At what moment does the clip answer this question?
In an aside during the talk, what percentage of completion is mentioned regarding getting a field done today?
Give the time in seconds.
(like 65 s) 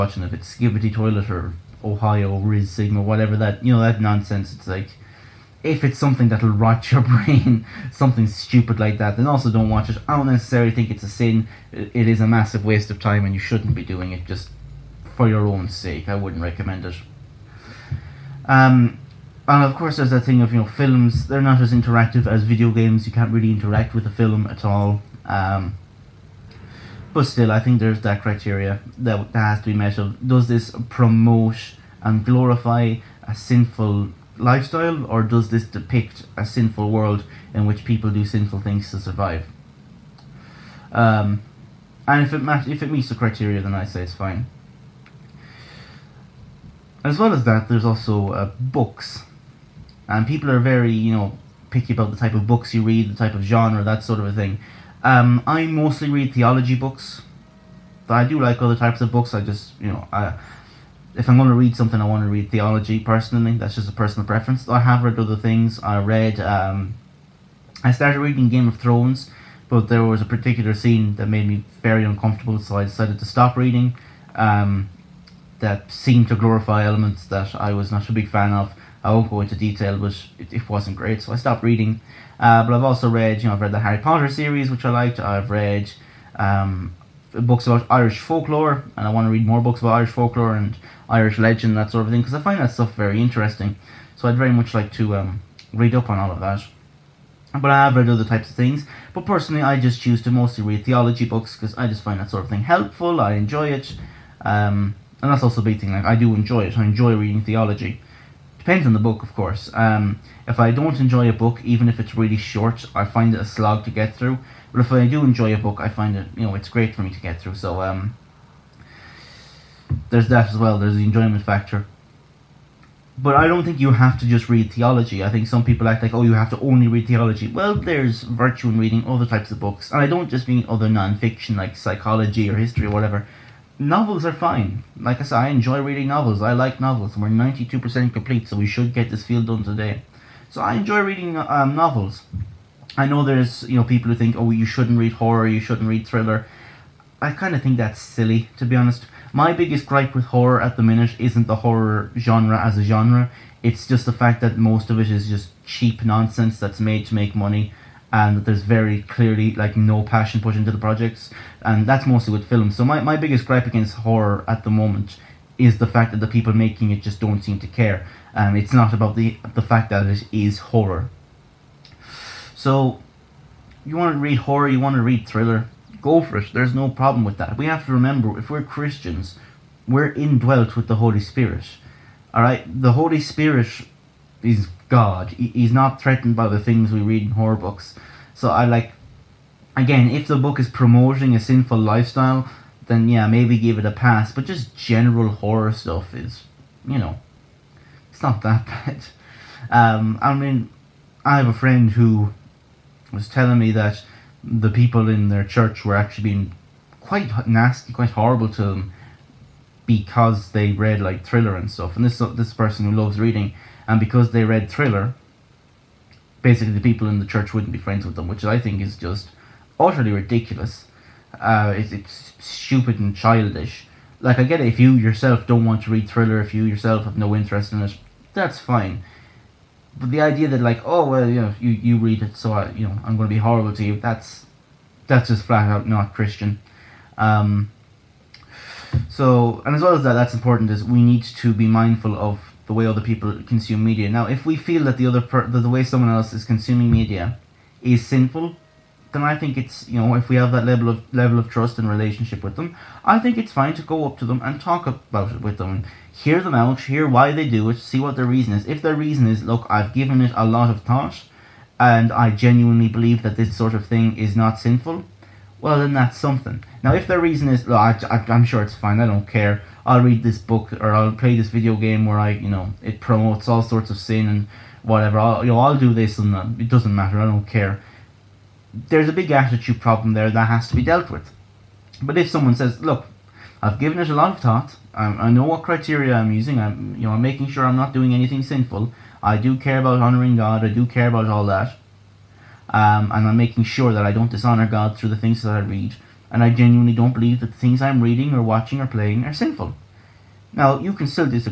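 137 s.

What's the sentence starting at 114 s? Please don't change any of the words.
But if I do enjoy a book, I find it, you know, it's great for me to get through.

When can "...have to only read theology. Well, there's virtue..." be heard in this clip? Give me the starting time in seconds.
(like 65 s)
126 s.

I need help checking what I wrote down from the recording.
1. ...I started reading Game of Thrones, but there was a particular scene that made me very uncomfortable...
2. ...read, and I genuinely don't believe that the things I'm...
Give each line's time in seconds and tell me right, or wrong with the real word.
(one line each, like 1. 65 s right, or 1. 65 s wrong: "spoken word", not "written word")
1. 67 s right
2. 295 s right.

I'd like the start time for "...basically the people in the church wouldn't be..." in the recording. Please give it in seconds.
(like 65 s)
216 s.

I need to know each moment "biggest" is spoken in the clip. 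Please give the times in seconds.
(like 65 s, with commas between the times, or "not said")
149 s, 163 s.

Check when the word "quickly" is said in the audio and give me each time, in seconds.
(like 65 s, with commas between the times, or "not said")
not said.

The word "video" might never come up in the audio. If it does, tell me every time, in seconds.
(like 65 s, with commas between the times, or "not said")
22 s, 271 s.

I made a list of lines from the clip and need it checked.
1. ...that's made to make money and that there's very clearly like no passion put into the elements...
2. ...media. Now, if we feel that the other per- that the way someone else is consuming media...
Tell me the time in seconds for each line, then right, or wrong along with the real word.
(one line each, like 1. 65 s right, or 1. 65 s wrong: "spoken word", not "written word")
1. 156 s wrong: "projects", not "elements"
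2. 243 s right.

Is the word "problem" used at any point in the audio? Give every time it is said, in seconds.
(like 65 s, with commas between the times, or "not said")
176 s, 279 s.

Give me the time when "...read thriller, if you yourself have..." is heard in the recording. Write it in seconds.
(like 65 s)
225 s.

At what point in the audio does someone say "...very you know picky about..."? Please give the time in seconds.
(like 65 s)
50 s.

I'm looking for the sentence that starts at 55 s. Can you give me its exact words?
Um, I mostly read theology books.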